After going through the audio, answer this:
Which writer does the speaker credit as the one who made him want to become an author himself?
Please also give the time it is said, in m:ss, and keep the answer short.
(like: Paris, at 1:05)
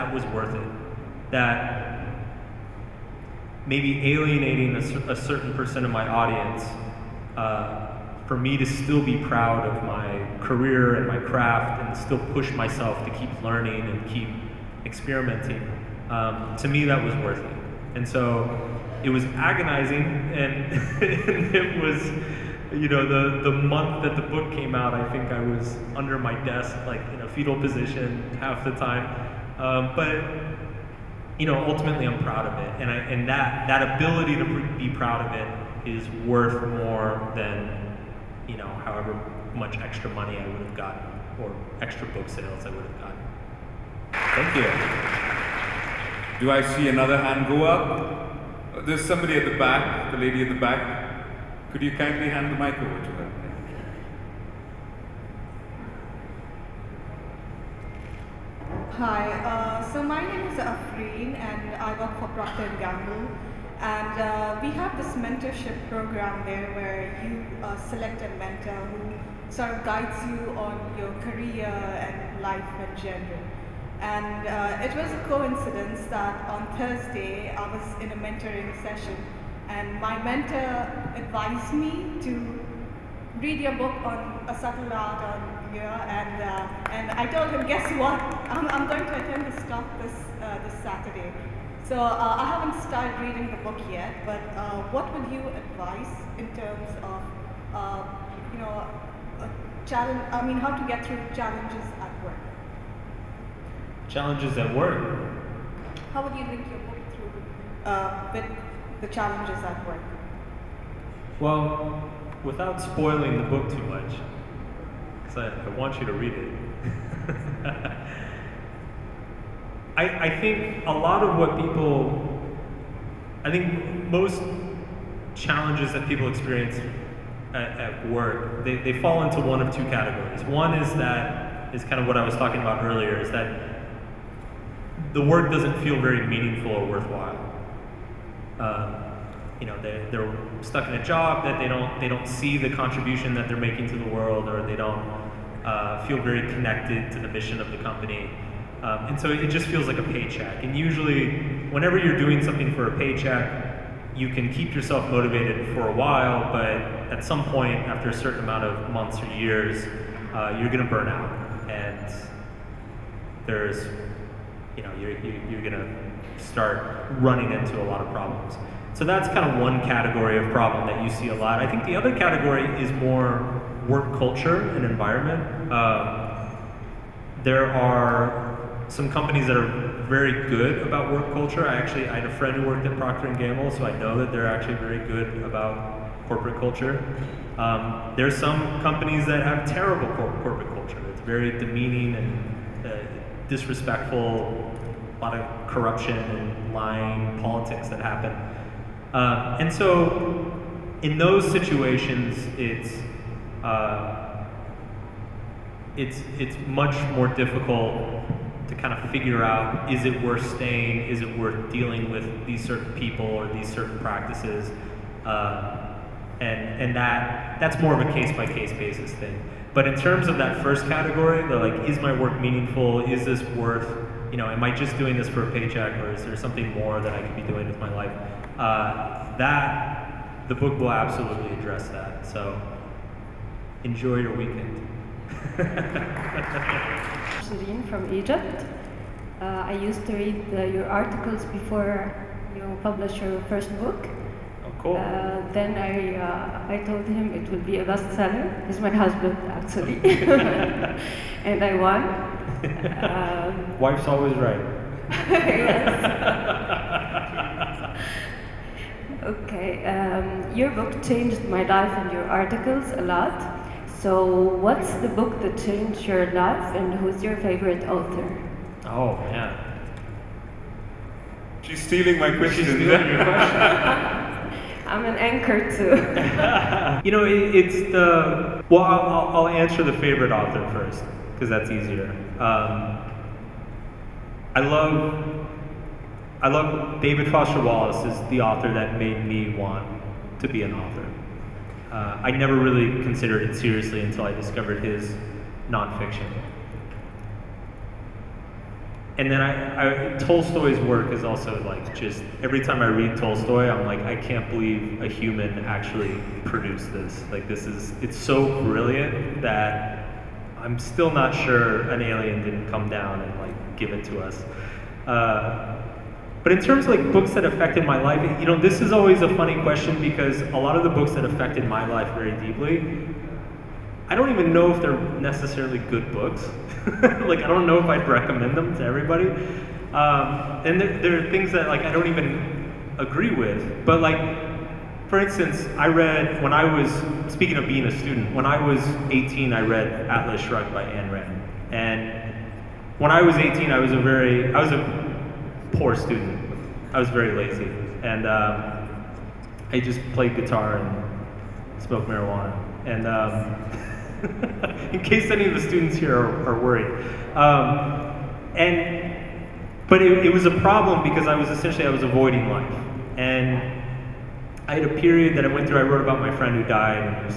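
David Foster Wallace, at 4:47.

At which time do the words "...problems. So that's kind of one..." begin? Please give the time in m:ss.
2:48.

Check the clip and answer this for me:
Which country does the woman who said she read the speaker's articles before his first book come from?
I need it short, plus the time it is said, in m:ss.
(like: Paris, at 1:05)
Egypt, at 3:58.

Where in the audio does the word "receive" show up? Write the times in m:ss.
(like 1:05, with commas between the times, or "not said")
not said.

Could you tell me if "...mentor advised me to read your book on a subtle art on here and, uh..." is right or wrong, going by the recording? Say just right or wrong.
right.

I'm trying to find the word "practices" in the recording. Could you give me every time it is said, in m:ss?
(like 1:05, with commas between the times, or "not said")
3:33.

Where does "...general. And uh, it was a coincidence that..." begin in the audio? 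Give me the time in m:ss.
1:13.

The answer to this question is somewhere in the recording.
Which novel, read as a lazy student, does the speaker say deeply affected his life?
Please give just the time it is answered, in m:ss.
5:40.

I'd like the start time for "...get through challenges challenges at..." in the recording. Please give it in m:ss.
1:40.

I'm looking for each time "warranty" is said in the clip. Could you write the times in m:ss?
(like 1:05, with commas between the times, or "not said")
not said.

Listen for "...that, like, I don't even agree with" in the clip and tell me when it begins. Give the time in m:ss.
5:31.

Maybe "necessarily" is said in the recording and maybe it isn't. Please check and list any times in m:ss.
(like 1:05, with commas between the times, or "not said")
5:25.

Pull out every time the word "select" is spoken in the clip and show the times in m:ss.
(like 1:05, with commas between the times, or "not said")
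1:07.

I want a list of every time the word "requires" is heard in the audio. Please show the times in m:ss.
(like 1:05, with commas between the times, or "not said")
not said.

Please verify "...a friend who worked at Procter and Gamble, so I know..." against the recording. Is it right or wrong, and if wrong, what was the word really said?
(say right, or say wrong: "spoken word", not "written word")
right.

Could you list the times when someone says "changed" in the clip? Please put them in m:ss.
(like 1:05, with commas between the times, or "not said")
4:21, 4:25.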